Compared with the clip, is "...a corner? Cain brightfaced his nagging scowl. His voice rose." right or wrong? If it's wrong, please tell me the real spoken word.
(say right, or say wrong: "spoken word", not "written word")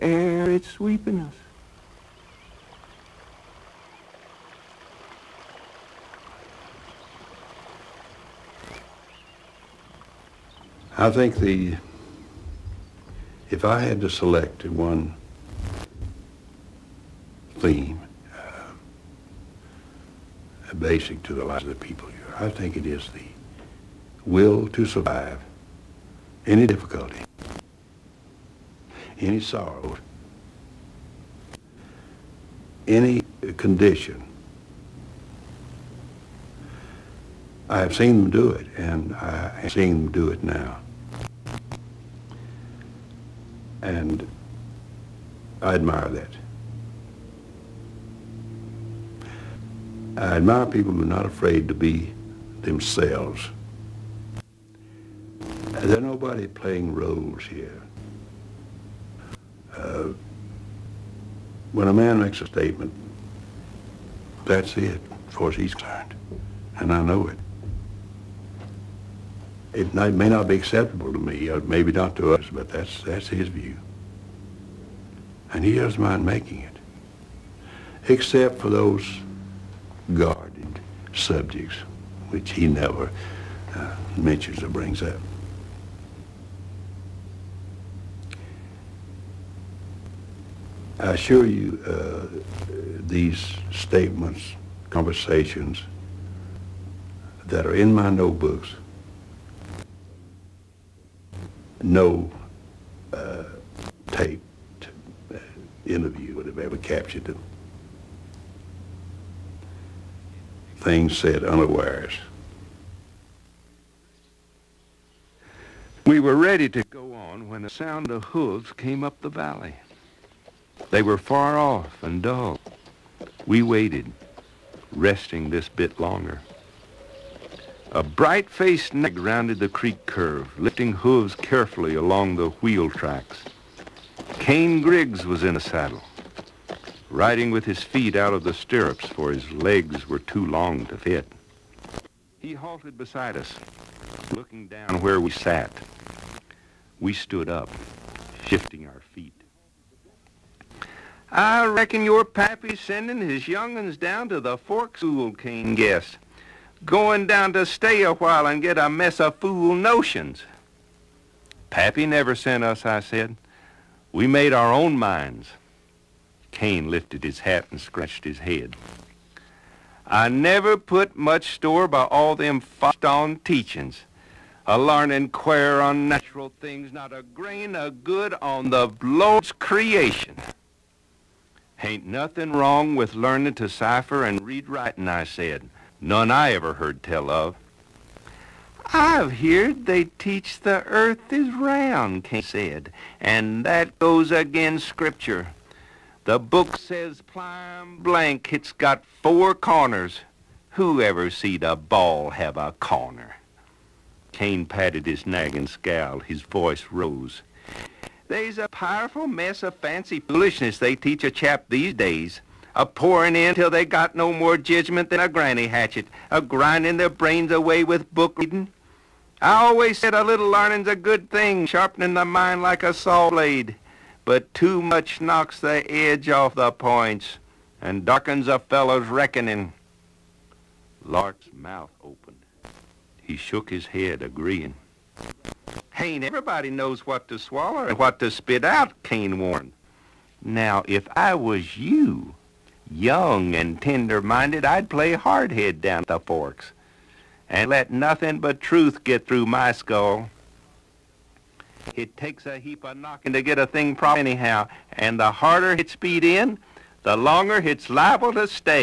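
wrong: "patted", not "brightfaced".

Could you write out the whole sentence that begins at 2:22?
He halted beside us, looking down where we sat.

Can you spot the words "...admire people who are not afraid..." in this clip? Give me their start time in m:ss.
0:50.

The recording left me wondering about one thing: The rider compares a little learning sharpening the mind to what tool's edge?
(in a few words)
saw blade.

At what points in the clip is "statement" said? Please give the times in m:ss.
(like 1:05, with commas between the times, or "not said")
1:02, 1:33.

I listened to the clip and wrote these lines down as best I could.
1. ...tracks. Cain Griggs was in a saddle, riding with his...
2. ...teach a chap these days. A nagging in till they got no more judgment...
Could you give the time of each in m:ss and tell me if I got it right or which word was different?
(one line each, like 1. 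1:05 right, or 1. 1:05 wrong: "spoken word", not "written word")
1. 2:12 right
2. 3:30 wrong: "pouring", not "nagging".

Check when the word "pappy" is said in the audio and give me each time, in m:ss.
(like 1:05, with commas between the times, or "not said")
2:32, 2:41.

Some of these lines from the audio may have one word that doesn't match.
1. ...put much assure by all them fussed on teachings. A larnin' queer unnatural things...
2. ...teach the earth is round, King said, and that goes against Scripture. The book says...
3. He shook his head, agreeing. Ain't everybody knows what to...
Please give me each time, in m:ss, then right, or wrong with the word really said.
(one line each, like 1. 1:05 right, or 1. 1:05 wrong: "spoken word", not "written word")
1. 2:50 wrong: "store", not "assure"
2. 3:10 right
3. 3:53 right.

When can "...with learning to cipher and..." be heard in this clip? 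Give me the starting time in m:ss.
3:02.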